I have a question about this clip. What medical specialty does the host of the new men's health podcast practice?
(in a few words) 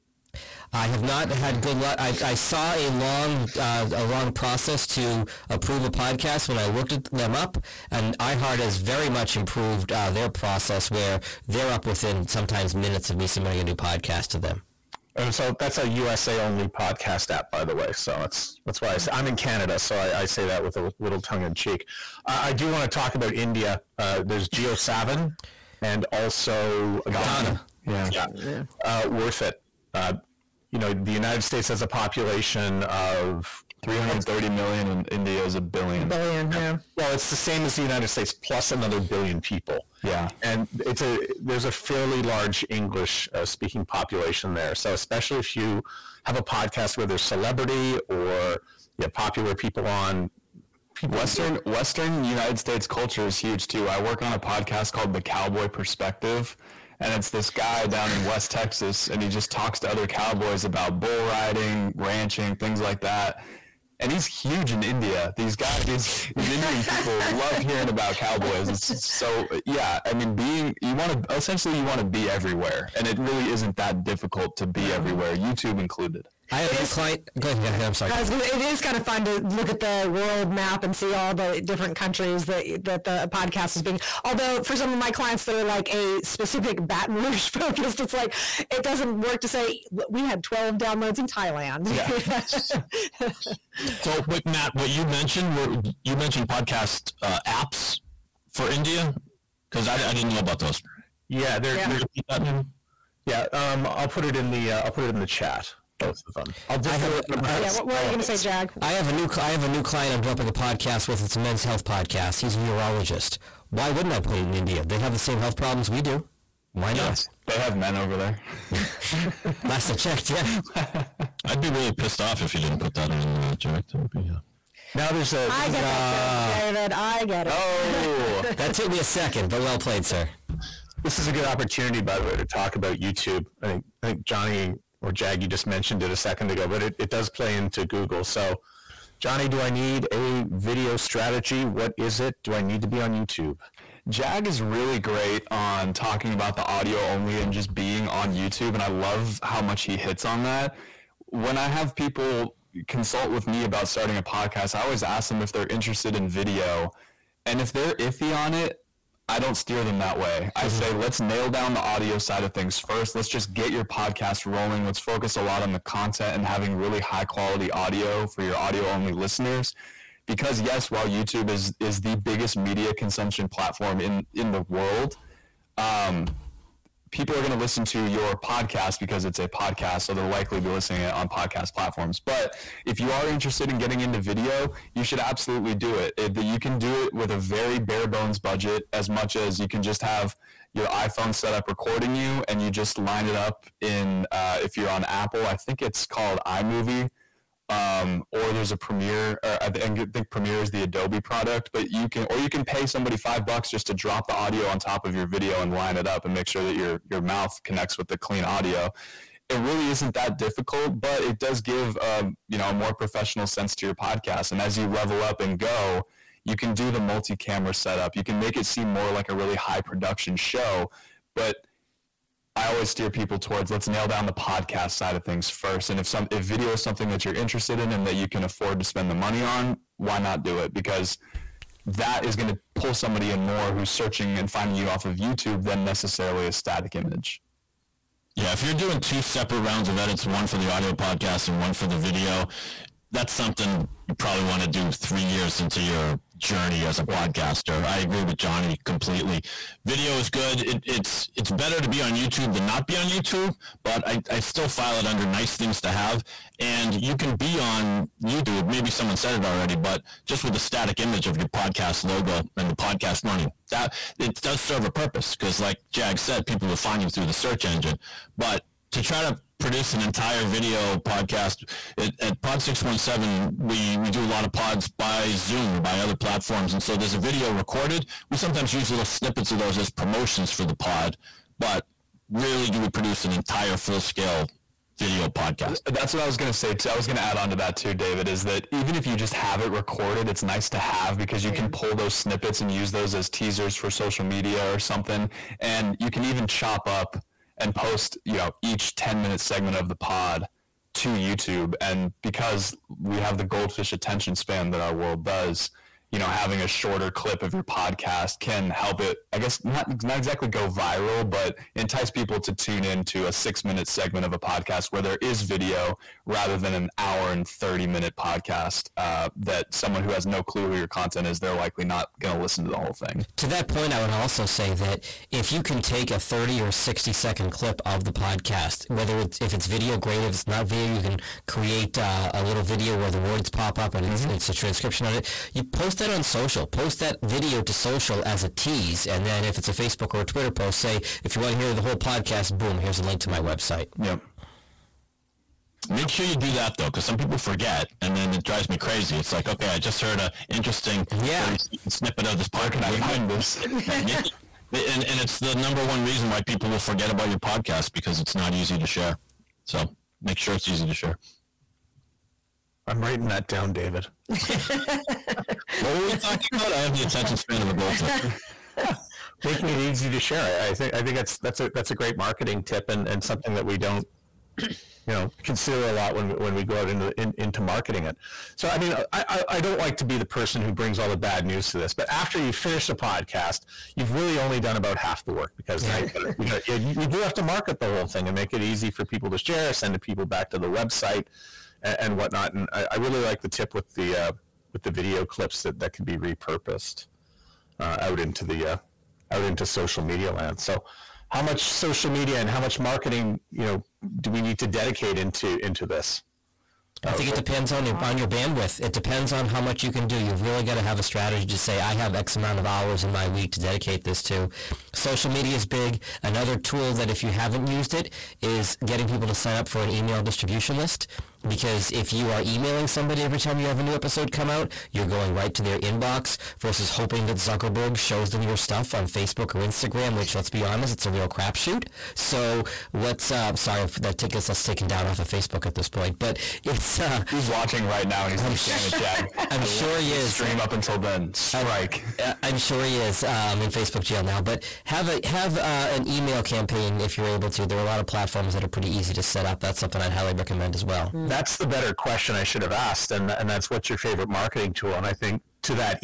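Urologist.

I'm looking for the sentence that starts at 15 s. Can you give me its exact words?
And so that's a USA only podcast app, by the way.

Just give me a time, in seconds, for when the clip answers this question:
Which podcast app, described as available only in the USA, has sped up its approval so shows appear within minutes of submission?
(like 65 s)
8 s.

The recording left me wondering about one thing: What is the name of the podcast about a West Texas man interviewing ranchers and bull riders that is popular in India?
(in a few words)
The Cowboy Perspective.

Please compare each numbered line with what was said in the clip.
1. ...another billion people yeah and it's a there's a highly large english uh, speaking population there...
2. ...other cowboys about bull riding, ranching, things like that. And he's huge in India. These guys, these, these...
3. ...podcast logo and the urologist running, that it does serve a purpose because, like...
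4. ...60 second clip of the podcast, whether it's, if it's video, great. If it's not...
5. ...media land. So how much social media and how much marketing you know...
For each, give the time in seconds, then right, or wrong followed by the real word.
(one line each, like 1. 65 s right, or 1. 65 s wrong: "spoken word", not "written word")
1. 38 s wrong: "fairly", not "highly"
2. 59 s right
3. 261 s wrong: "podcast", not "urologist"
4. 326 s right
5. 400 s right.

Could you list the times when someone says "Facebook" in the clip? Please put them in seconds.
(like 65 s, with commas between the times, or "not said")
339 s, 429 s, 435 s, 443 s.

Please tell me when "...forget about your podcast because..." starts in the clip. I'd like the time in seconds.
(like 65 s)
356 s.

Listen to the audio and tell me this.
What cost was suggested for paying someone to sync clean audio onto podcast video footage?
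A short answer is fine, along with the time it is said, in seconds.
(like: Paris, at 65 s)
5 dollars, at 203 s.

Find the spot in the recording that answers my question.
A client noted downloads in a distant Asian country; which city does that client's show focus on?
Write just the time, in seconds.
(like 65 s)
86 s.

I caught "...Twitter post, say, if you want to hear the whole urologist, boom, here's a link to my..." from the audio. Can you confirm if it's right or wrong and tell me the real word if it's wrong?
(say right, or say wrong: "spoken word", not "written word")
wrong: "podcast", not "urologist".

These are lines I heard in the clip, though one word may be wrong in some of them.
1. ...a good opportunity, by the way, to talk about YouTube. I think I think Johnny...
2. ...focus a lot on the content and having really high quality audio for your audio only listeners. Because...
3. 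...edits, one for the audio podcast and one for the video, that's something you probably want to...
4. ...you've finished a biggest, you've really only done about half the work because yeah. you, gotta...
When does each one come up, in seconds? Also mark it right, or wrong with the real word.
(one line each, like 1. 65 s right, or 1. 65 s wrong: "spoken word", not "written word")
1. 131 s right
2. 164 s right
3. 239 s right
4. 382 s wrong: "podcast", not "biggest".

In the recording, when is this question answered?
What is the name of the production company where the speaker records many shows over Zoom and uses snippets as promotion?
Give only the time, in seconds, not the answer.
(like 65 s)
272 s.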